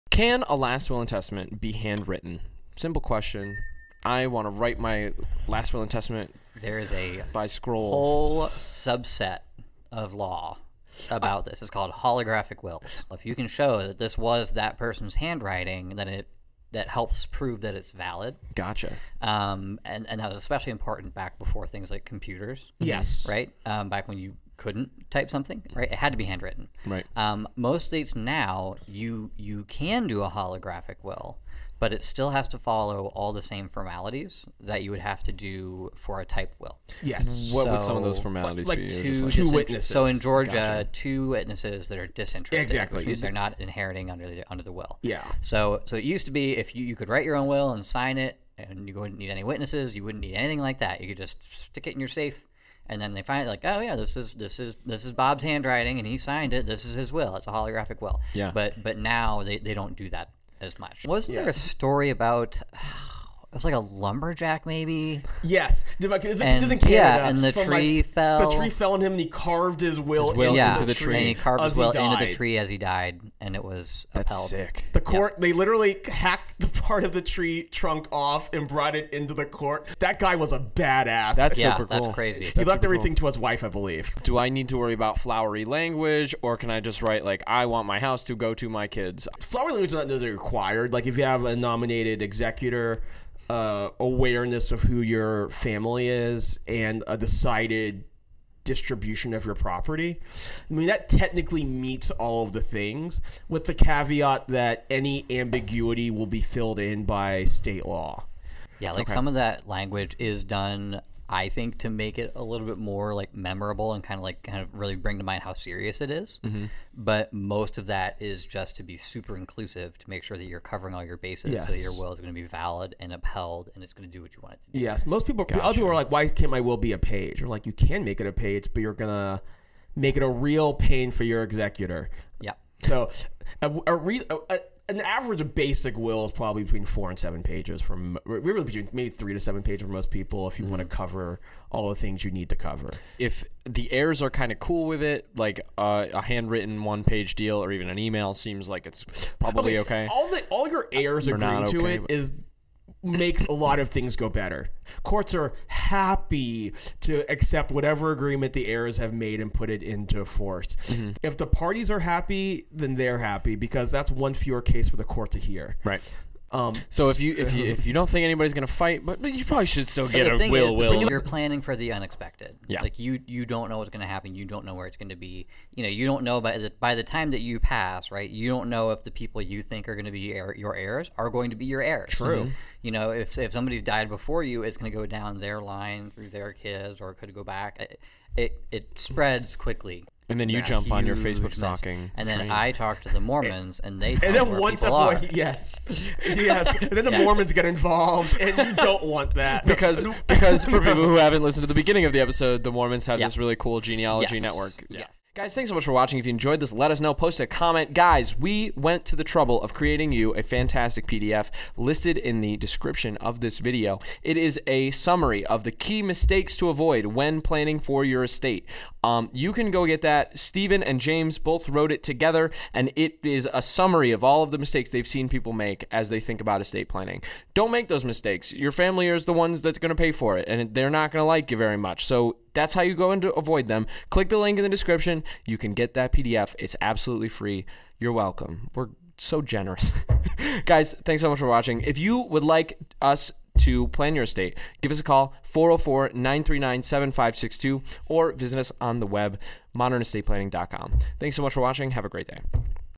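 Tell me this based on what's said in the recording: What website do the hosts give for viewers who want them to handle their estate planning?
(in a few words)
modernestateplanning.com.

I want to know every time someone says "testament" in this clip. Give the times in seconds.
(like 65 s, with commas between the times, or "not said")
1 s, 5 s.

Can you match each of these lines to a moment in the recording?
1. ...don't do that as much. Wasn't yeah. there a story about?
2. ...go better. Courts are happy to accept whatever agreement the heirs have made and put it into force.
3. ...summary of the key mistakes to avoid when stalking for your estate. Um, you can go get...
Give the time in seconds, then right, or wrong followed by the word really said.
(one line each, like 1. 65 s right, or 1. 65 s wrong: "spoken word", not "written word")
1. 59 s right
2. 154 s right
3. 214 s wrong: "planning", not "stalking".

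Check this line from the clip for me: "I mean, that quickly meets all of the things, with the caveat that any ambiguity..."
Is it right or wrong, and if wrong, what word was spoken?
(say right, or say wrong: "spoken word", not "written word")
wrong: "technically", not "quickly".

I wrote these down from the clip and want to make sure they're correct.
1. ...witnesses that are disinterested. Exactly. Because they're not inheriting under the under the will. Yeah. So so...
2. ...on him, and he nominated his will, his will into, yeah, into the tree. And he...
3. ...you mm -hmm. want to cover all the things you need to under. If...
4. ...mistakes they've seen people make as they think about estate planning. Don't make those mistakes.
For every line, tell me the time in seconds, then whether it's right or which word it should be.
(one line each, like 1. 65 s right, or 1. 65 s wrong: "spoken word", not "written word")
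1. 41 s right
2. 68 s wrong: "carved", not "nominated"
3. 140 s wrong: "cover", not "under"
4. 224 s right.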